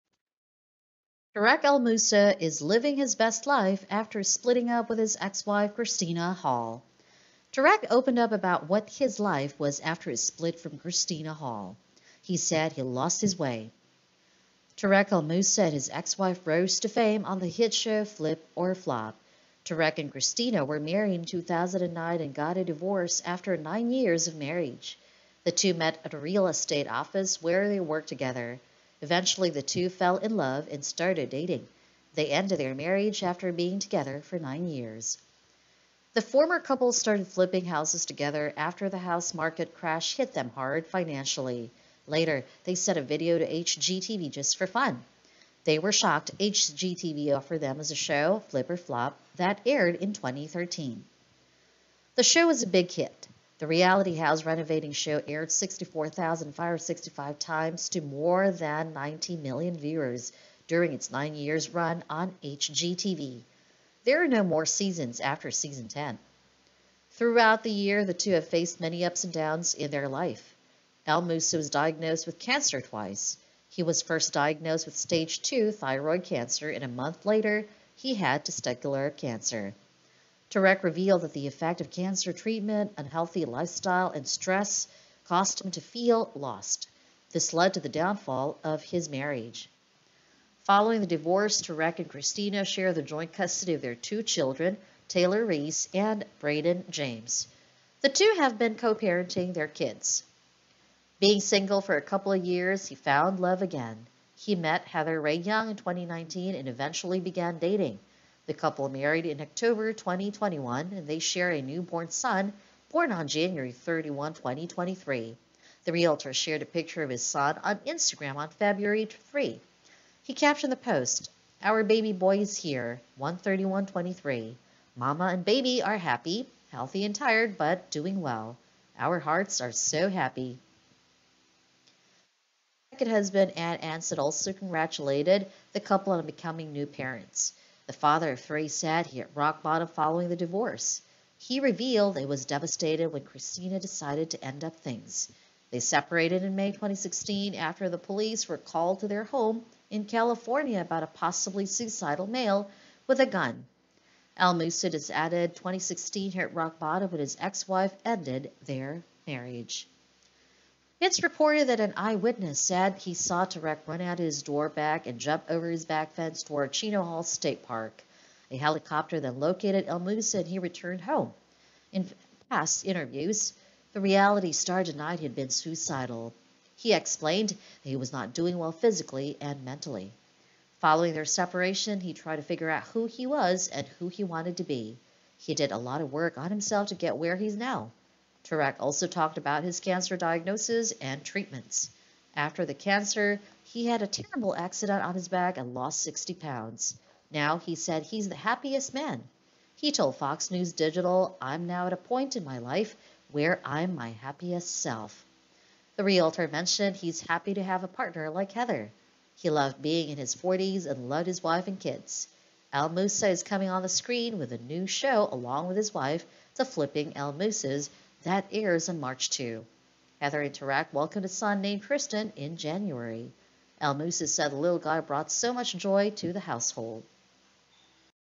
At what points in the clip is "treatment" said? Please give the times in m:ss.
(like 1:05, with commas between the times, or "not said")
1:22, 3:11.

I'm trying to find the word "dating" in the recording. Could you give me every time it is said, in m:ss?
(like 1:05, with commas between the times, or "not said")
0:31, 1:47.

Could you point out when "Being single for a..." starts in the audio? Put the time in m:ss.
1:41.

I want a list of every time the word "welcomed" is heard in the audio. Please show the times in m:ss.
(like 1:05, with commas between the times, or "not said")
3:40.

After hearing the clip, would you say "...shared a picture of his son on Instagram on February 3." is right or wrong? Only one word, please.
right.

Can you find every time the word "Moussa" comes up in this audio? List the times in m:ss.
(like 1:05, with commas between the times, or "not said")
0:01, 0:15, 1:11, 2:49, 3:32, 3:37, 3:43.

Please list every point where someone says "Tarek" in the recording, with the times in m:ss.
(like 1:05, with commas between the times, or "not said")
0:01, 0:07, 0:14, 0:19, 1:20, 1:31, 2:43, 3:08.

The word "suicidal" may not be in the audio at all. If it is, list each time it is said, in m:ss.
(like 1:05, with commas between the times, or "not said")
2:31, 2:55.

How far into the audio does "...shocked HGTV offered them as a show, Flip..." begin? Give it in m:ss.
0:45.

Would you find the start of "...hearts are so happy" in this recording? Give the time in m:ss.
2:09.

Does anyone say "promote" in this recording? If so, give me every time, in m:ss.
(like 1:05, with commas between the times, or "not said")
not said.